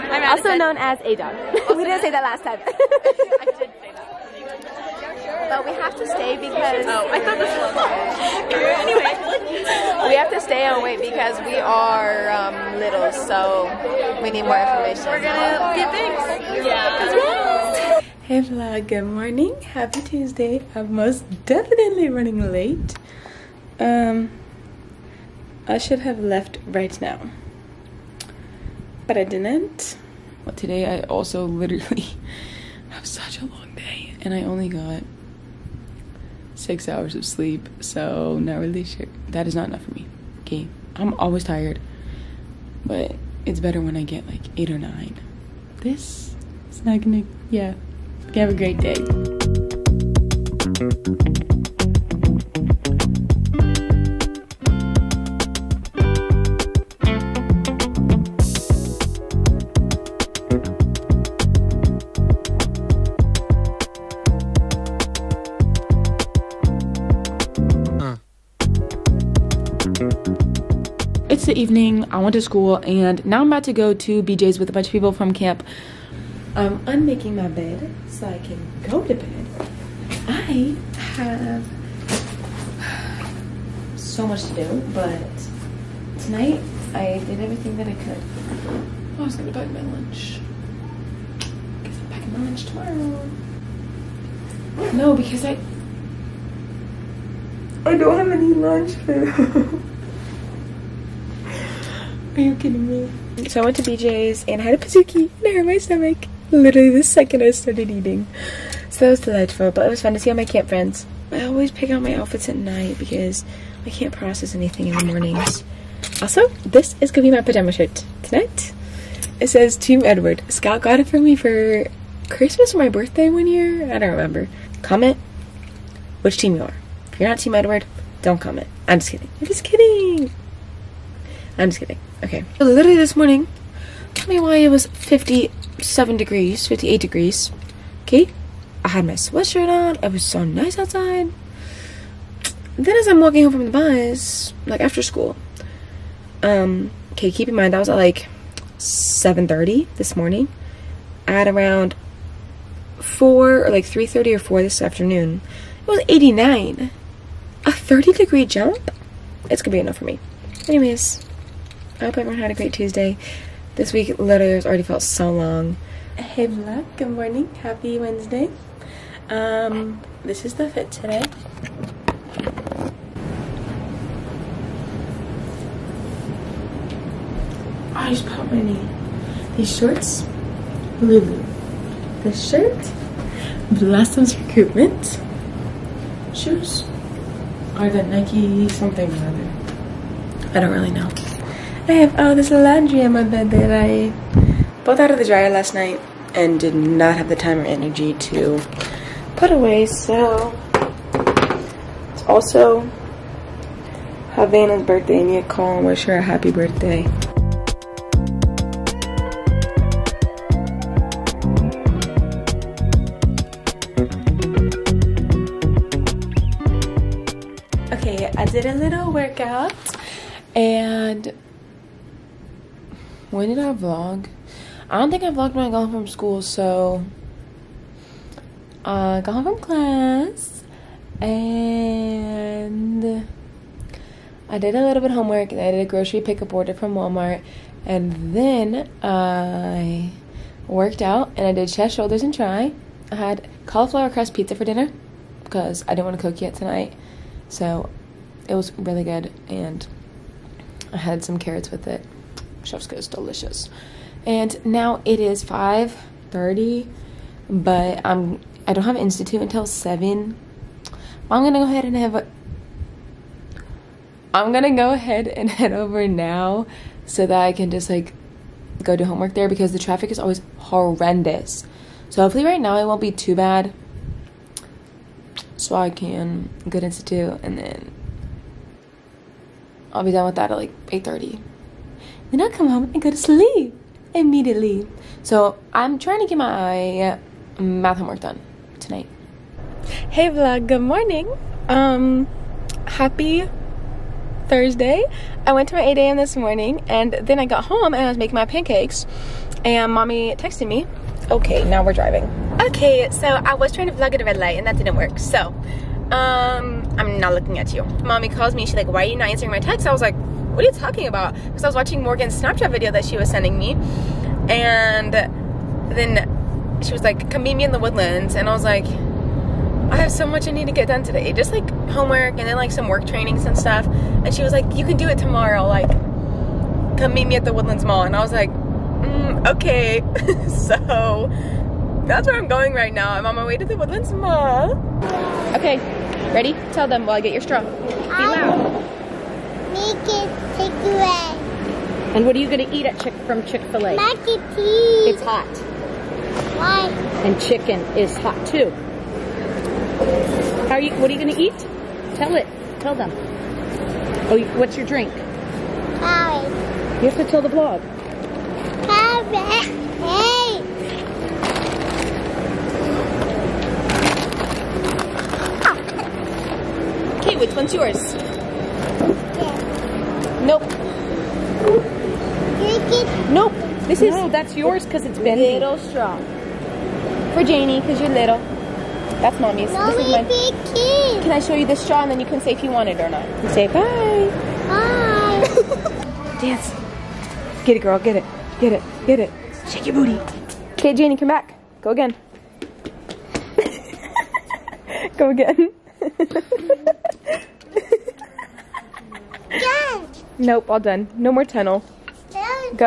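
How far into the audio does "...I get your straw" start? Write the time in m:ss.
5:37.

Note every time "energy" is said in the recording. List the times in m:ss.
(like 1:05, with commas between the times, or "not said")
3:17.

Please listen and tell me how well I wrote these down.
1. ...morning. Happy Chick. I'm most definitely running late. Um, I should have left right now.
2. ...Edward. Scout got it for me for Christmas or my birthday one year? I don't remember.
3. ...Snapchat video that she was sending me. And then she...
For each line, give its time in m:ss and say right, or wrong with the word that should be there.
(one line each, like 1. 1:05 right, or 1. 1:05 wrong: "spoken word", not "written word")
1. 0:19 wrong: "Tuesday", not "Chick"
2. 2:00 right
3. 5:12 right.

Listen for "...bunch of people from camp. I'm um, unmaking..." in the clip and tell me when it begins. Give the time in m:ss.
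1:14.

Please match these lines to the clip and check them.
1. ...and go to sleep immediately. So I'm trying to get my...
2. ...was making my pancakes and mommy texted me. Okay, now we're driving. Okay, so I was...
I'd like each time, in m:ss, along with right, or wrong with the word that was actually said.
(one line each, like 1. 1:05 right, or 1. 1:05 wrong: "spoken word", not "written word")
1. 4:42 right
2. 4:58 right.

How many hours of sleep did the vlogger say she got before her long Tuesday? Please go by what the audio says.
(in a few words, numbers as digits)
6.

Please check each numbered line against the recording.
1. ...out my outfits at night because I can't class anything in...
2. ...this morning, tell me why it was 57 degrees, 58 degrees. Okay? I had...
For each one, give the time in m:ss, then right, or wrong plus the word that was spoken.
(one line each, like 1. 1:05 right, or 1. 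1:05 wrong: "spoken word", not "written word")
1. 1:51 wrong: "process", not "class"
2. 2:12 right.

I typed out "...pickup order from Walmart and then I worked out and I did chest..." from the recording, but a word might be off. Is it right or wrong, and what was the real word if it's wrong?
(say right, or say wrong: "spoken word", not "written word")
right.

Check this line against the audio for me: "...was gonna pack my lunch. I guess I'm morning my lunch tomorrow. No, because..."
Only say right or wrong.
wrong.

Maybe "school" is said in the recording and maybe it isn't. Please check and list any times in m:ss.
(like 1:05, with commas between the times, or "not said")
1:12, 2:25, 3:46.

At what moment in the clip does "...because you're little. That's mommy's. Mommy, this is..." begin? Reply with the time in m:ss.
6:17.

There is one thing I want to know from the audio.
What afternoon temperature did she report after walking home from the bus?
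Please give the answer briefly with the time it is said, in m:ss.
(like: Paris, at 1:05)
89, at 2:36.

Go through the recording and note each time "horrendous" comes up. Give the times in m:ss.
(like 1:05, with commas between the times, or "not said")
4:30.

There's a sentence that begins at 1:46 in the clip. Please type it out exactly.
Literally the second I started eating.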